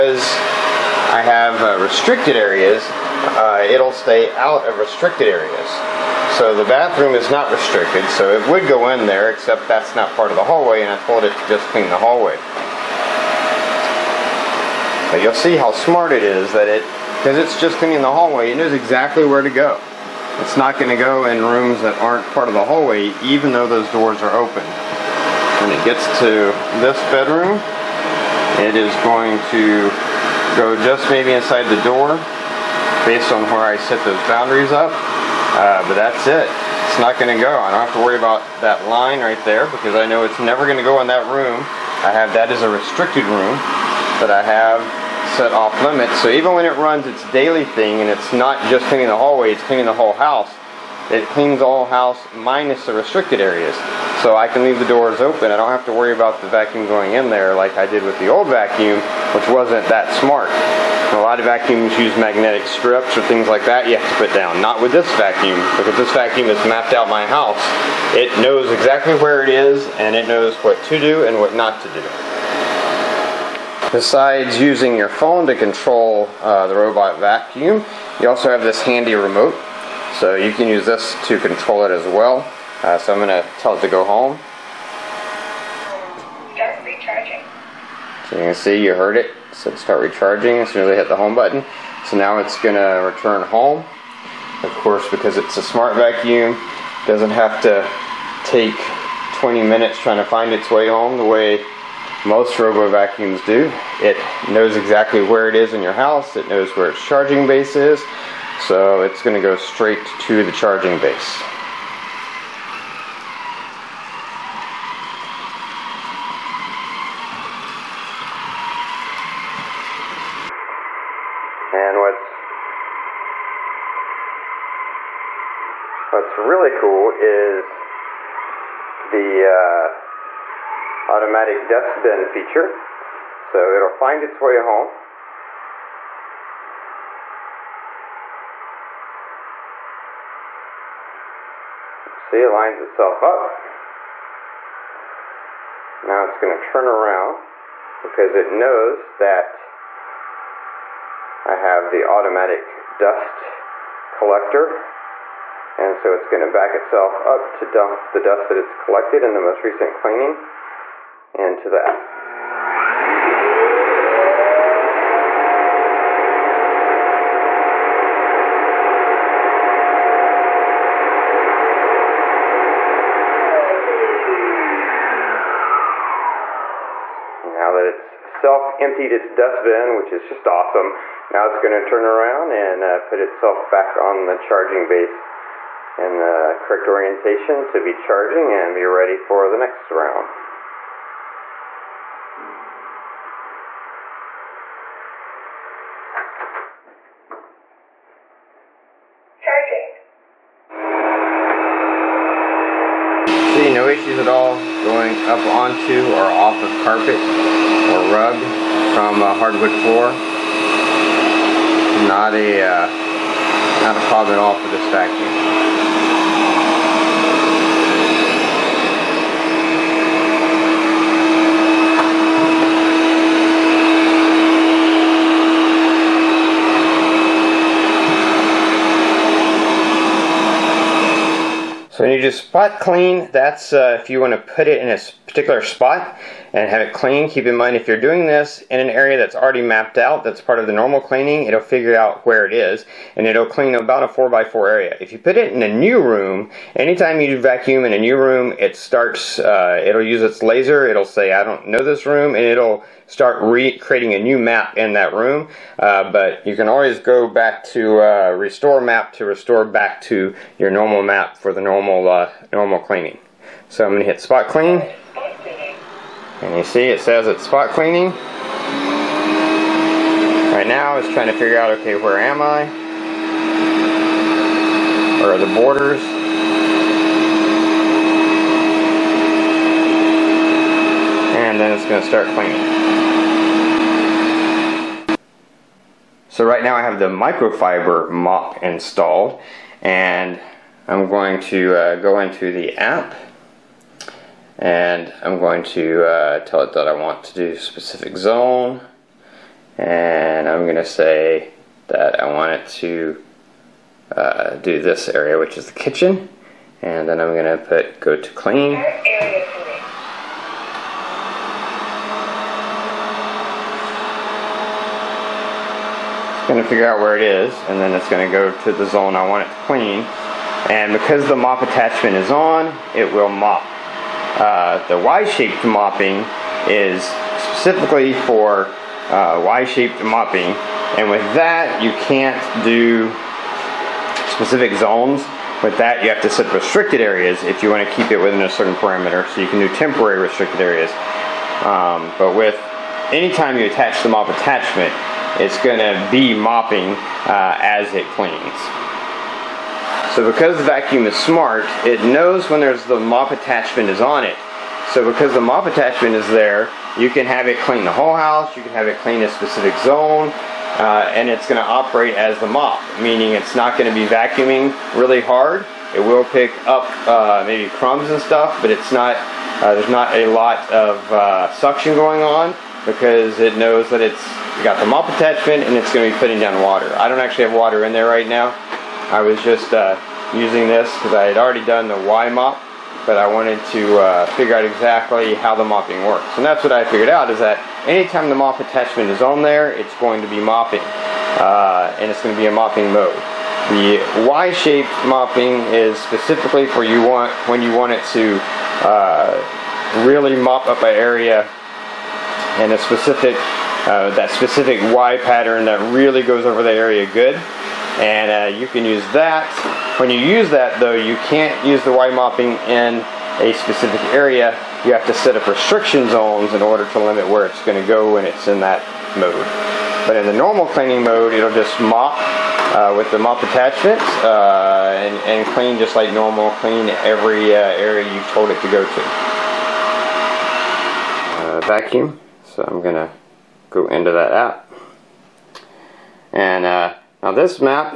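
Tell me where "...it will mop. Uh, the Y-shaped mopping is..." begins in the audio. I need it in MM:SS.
05:22.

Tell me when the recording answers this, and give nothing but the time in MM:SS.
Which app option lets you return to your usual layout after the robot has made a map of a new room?
04:18.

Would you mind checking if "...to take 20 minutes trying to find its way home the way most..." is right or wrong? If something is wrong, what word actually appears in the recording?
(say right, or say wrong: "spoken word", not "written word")
right.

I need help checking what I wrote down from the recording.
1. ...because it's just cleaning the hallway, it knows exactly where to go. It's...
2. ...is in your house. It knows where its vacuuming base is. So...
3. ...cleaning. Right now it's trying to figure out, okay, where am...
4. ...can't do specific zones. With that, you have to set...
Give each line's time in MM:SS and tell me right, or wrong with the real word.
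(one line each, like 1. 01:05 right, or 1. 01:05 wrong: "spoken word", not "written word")
1. 00:17 right
2. 01:45 wrong: "charging", not "vacuuming"
3. 04:27 right
4. 05:32 right.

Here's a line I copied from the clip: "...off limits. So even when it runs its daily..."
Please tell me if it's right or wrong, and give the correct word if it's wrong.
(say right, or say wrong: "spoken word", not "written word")
right.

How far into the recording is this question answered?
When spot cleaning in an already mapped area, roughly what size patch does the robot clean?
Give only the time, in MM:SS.
04:04.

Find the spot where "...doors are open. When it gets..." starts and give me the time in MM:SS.
00:23.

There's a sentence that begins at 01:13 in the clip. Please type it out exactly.
Besides using your phone to control uh, the robot vacuum, you also have this handy remote.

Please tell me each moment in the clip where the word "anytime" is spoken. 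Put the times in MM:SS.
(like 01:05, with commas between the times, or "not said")
04:06, 05:43, 06:27.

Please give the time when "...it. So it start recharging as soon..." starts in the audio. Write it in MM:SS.
01:29.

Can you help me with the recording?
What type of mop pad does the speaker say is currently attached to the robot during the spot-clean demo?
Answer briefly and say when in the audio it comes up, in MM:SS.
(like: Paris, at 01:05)
microfiber mop, at 04:47.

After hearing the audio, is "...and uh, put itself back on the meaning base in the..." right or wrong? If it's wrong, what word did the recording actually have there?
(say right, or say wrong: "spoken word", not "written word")
wrong: "charging", not "meaning".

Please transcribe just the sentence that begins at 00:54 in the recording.
So I can leave the doors open.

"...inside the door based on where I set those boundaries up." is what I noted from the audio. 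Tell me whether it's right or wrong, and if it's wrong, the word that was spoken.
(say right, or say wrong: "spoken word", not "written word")
right.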